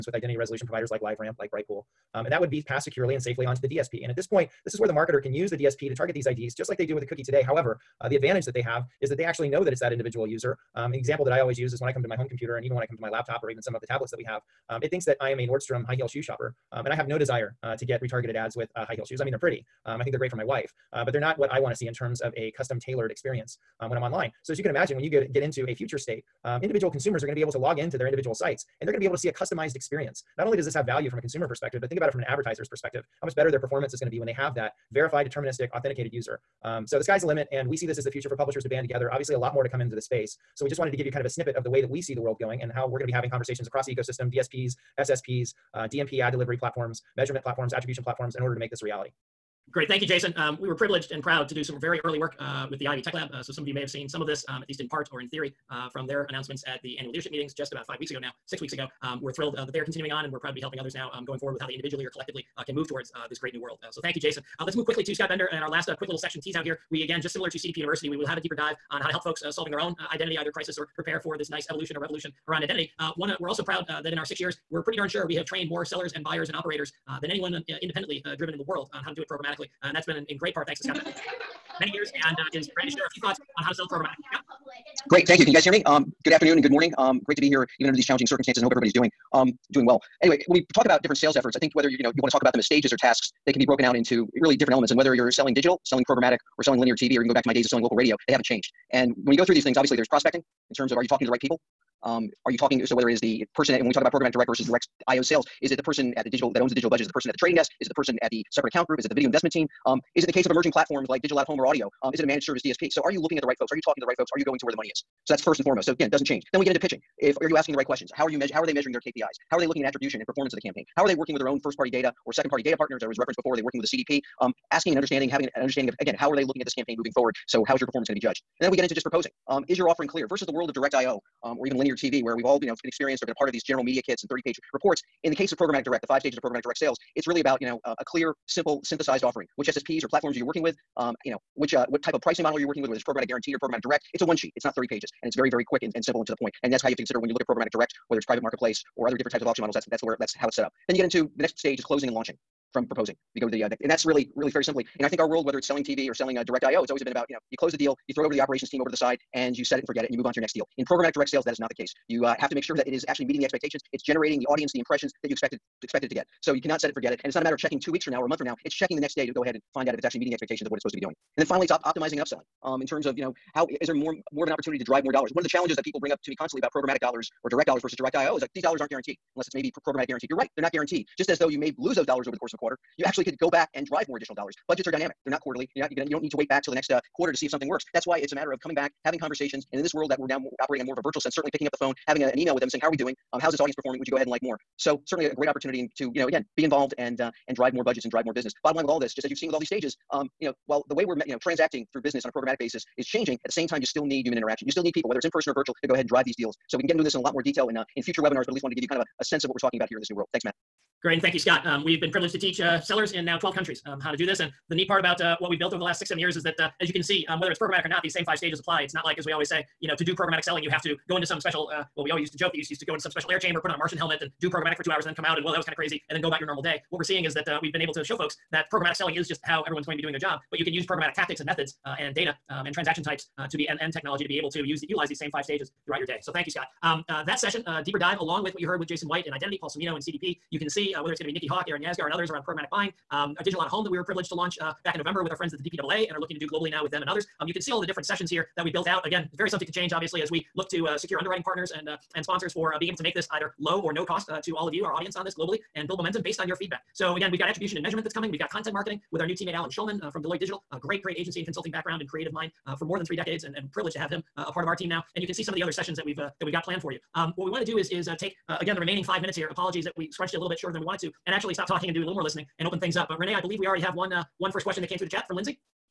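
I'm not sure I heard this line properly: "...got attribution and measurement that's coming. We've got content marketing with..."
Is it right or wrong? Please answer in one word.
right.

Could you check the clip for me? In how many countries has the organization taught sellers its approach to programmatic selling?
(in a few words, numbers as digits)
12.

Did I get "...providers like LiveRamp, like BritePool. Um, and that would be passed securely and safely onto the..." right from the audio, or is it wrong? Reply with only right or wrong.
right.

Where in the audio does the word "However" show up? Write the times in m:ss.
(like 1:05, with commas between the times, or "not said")
0:07.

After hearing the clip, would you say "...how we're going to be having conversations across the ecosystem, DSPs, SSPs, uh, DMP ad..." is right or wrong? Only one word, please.
right.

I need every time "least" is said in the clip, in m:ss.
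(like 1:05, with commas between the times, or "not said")
0:54, 3:28.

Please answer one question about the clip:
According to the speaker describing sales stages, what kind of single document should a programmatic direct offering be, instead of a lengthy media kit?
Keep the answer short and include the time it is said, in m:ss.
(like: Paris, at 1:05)
One sheet, at 2:24.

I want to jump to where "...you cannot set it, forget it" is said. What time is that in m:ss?
2:46.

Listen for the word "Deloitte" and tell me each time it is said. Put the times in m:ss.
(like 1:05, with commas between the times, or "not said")
4:20.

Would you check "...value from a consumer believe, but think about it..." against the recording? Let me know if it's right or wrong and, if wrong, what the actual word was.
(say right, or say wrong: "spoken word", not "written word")
wrong: "perspective", not "believe".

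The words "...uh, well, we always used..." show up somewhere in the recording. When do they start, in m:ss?
3:41.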